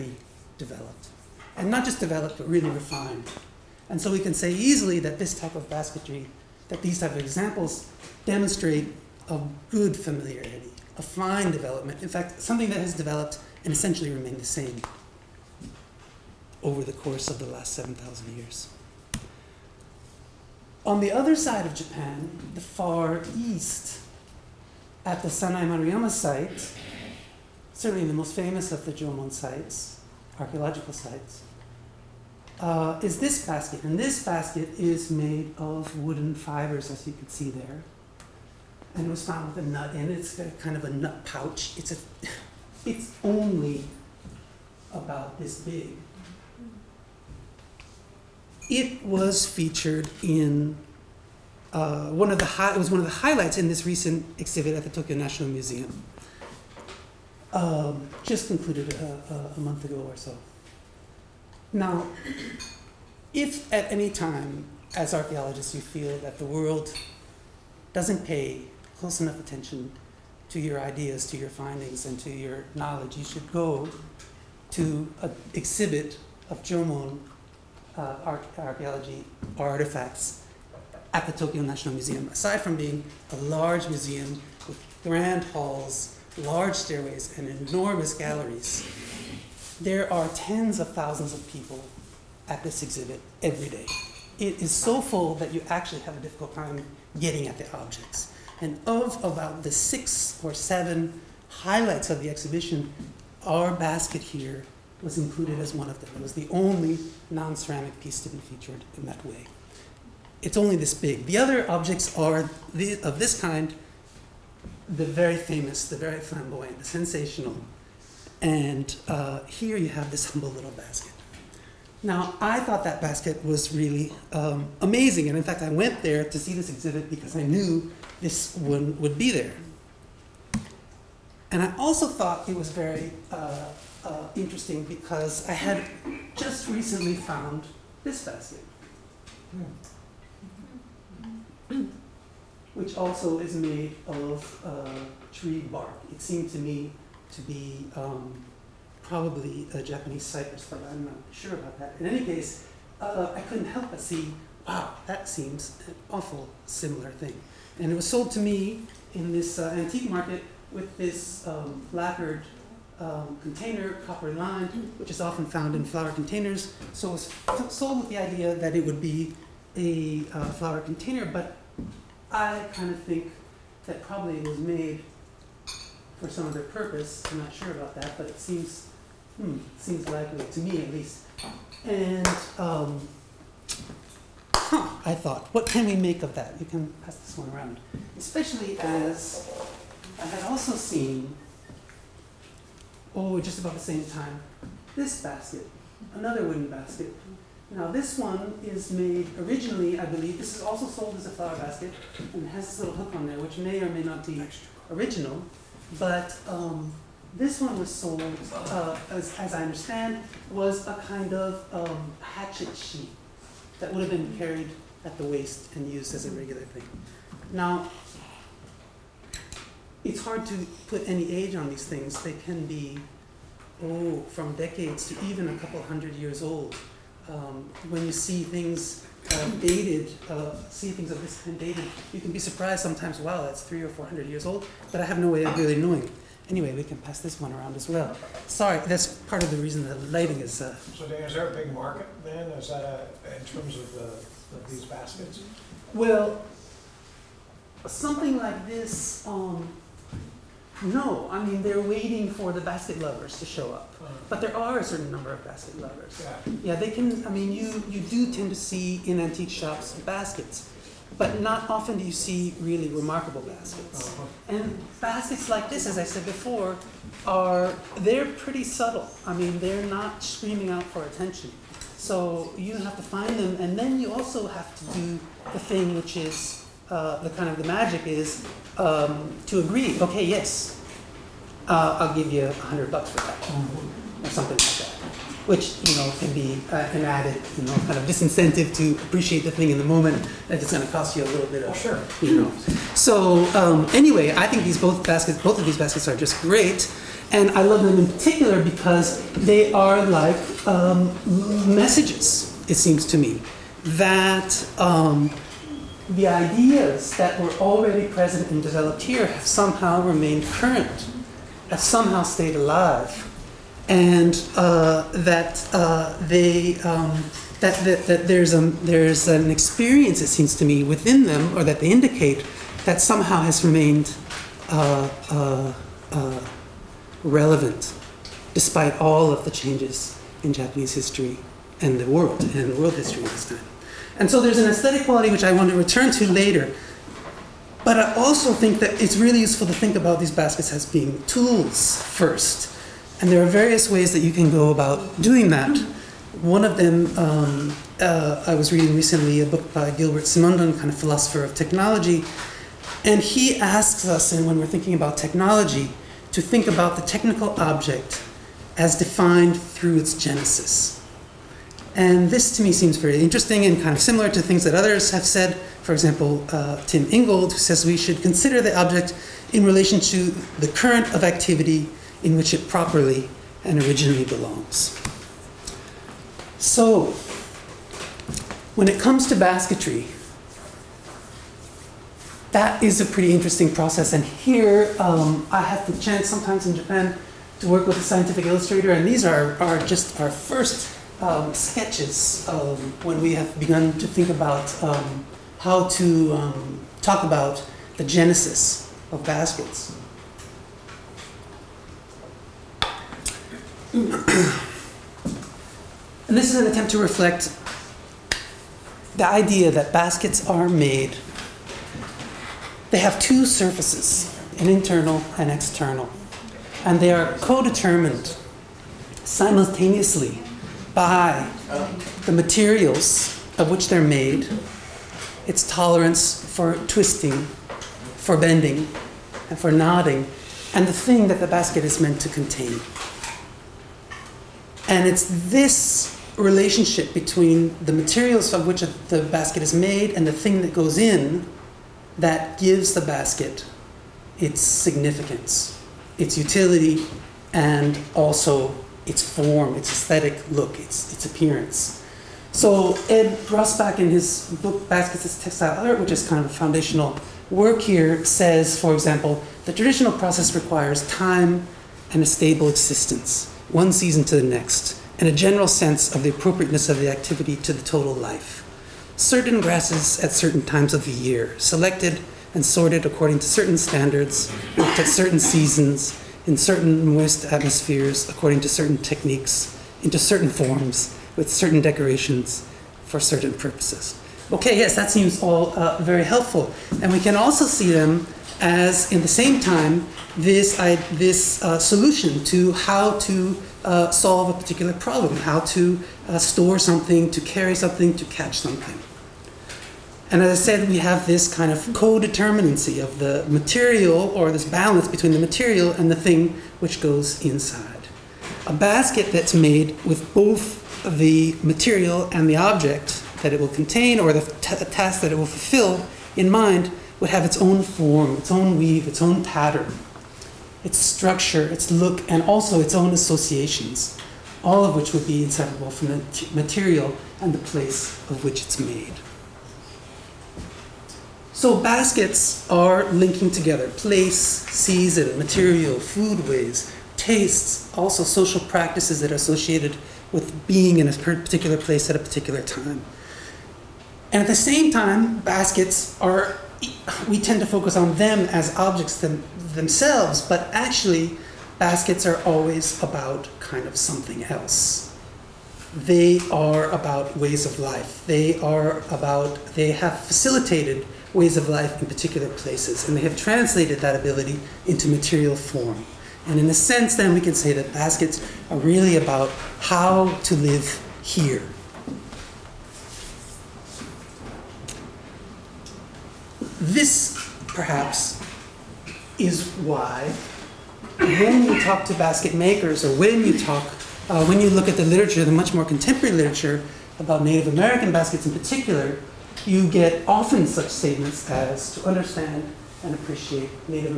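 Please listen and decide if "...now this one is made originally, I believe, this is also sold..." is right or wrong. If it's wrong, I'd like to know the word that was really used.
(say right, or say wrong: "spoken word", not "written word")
right.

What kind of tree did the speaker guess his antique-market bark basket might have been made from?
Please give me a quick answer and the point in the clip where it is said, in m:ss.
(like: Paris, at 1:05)
Japanese cypress, at 2:29.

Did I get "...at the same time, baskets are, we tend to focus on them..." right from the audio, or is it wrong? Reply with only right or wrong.
right.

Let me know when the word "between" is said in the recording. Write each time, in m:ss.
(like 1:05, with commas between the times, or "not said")
7:17, 8:25.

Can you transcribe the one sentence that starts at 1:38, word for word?
And of about the six or seven highlights of the exhibition, our basket here was included as one of them.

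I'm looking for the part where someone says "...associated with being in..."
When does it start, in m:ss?
8:59.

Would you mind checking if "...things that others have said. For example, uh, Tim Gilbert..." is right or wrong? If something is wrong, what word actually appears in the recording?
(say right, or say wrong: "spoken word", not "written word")
wrong: "Ingold", not "Gilbert".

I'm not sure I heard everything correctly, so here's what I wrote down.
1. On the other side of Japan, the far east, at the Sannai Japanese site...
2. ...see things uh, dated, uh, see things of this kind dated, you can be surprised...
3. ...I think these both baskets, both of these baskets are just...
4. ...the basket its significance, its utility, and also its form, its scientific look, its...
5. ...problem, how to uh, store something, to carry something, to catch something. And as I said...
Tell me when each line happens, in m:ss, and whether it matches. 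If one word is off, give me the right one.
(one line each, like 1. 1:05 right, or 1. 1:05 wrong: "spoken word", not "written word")
1. 0:20 wrong: "Maruyama", not "Japanese"
2. 3:48 right
3. 4:54 right
4. 7:22 wrong: "aesthetic", not "scientific"
5. 8:14 right.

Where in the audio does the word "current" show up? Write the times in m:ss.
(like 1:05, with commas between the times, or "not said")
5:10, 6:10.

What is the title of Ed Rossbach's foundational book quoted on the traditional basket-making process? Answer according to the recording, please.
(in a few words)
Baskets as Textile Art.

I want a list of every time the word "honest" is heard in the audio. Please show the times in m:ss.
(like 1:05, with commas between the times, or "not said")
not said.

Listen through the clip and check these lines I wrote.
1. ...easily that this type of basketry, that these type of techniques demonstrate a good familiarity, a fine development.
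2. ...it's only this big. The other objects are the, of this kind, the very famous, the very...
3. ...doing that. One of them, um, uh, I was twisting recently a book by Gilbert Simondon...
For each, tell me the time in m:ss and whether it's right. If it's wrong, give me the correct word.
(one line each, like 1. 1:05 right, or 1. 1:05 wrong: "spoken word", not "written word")
1. 0:04 wrong: "examples", not "techniques"
2. 1:50 right
3. 5:45 wrong: "reading", not "twisting".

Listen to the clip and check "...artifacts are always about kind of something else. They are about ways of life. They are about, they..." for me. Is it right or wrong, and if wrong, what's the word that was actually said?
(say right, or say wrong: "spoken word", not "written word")
wrong: "baskets", not "artifacts".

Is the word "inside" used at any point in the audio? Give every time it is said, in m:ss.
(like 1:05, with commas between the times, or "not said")
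8:27.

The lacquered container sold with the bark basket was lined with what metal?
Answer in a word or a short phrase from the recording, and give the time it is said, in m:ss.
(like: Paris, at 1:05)
Copper, at 2:44.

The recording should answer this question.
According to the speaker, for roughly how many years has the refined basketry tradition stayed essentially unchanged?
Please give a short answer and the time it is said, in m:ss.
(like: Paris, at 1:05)
7,000 years, at 0:17.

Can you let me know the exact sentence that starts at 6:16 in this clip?
So, when it comes to basketry, that is a pretty interesting process.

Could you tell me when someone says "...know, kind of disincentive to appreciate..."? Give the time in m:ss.
4:47.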